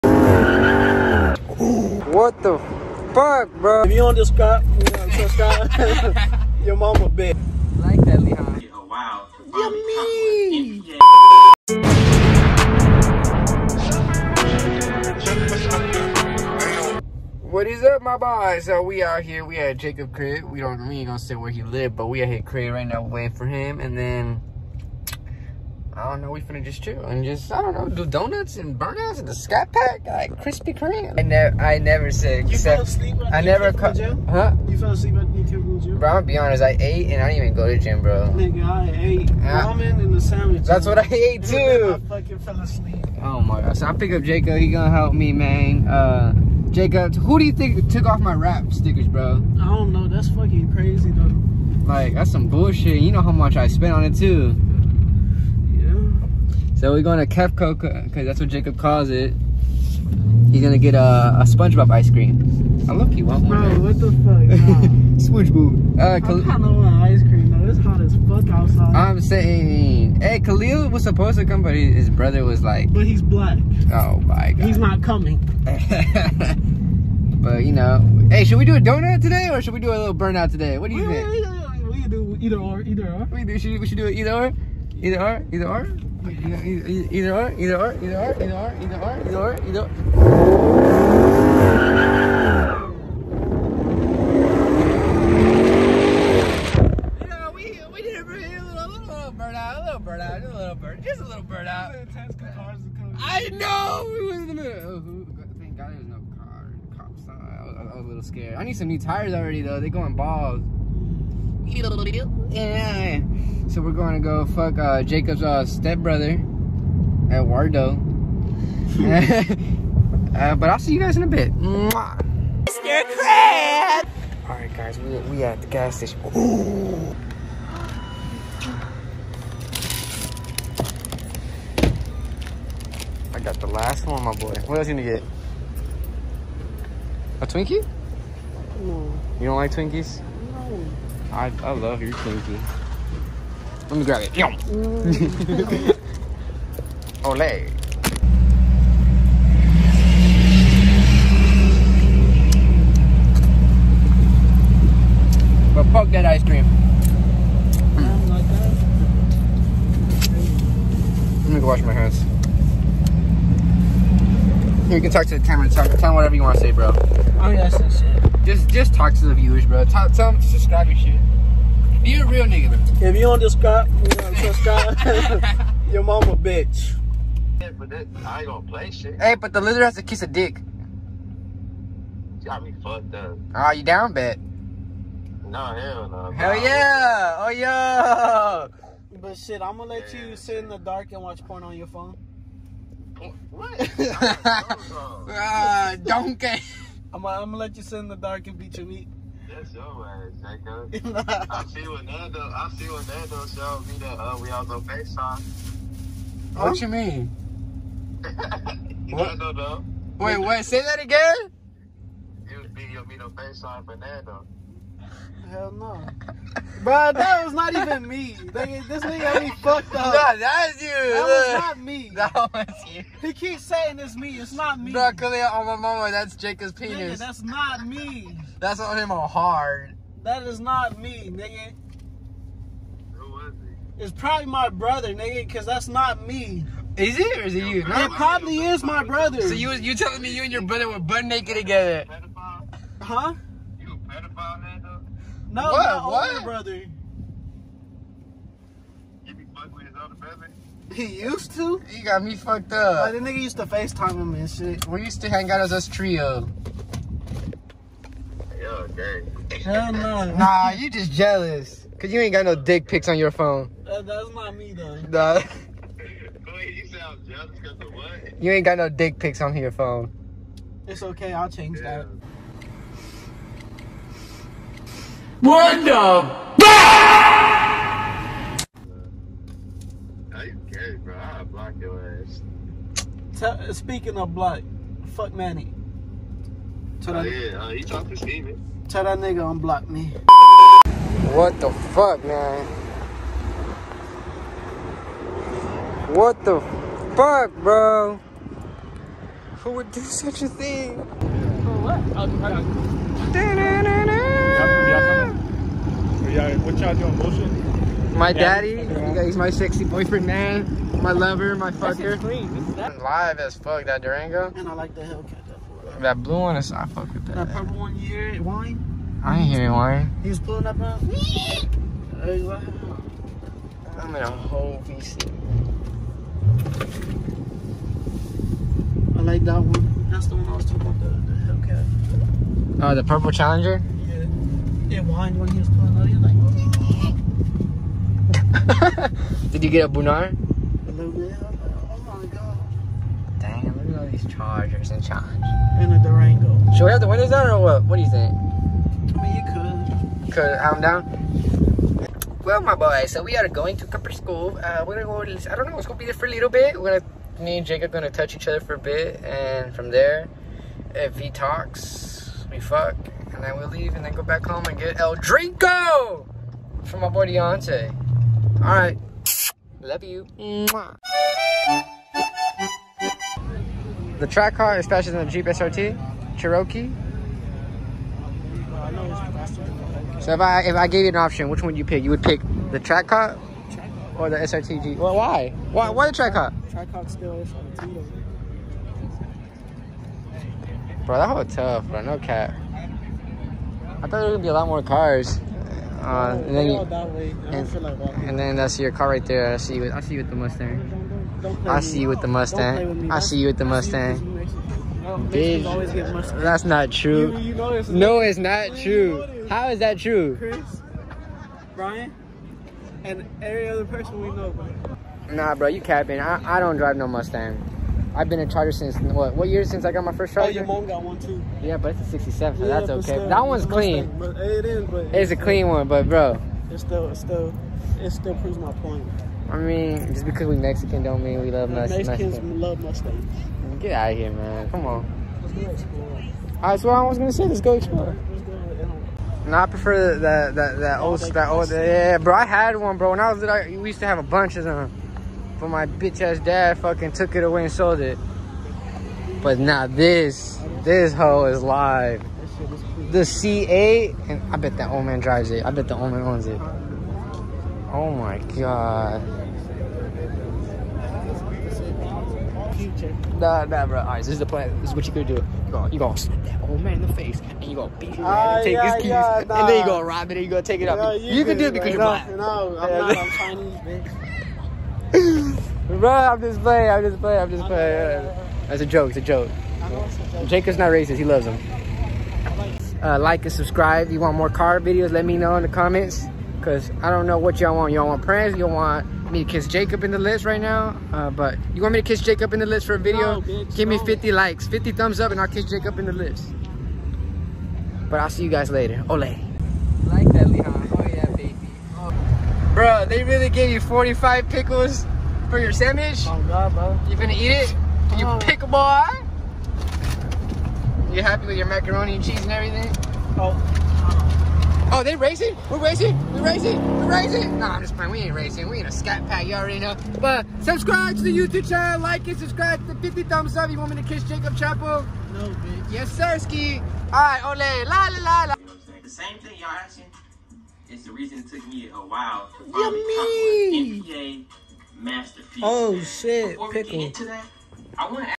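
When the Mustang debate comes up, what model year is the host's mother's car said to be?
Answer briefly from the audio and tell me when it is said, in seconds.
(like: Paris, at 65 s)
'67, at 422 s.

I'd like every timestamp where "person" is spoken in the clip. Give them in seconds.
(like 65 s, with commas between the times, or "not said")
413 s.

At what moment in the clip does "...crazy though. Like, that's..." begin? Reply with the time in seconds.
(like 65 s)
50 s.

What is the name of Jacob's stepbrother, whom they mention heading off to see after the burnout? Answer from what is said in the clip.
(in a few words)
Eduardo.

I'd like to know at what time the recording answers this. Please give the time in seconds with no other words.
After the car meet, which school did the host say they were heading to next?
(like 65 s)
353 s.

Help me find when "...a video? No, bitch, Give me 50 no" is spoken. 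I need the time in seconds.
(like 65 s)
492 s.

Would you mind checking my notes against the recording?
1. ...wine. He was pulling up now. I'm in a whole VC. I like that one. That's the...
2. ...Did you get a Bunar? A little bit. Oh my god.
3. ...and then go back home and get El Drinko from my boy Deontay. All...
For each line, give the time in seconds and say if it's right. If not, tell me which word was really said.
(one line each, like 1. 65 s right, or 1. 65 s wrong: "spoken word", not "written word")
1. 319 s right
2. 339 s right
3. 363 s right.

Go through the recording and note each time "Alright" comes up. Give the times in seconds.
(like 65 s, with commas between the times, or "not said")
124 s, 463 s.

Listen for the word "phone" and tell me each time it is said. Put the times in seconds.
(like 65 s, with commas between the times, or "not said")
191 s, 263 s, 269 s.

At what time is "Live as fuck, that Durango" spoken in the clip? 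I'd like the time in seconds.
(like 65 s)
313 s.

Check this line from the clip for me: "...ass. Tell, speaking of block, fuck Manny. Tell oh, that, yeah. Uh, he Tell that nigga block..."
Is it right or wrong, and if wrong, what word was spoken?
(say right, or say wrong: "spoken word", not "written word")
wrong: "unblock", not "block".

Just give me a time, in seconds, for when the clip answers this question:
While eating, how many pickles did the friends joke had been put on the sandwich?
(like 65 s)
503 s.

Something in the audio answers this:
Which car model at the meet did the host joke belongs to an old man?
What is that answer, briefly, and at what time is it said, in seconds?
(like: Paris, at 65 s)
C8, at 453 s.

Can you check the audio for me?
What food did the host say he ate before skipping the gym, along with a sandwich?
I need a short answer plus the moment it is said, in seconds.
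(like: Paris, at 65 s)
Ramen, at 39 s.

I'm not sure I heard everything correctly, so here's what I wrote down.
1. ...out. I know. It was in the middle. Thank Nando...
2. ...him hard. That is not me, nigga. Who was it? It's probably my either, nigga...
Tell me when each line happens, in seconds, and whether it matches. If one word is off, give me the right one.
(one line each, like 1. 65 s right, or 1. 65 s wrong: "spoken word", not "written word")
1. 101 s wrong: "God", not "Nando"
2. 228 s wrong: "brother", not "either".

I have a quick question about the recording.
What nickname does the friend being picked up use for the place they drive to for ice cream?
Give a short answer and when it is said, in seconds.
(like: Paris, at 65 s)
Kefco, at 57 s.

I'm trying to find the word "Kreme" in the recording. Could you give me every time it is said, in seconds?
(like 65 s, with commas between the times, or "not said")
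30 s.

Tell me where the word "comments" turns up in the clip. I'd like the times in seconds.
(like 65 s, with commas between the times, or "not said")
485 s.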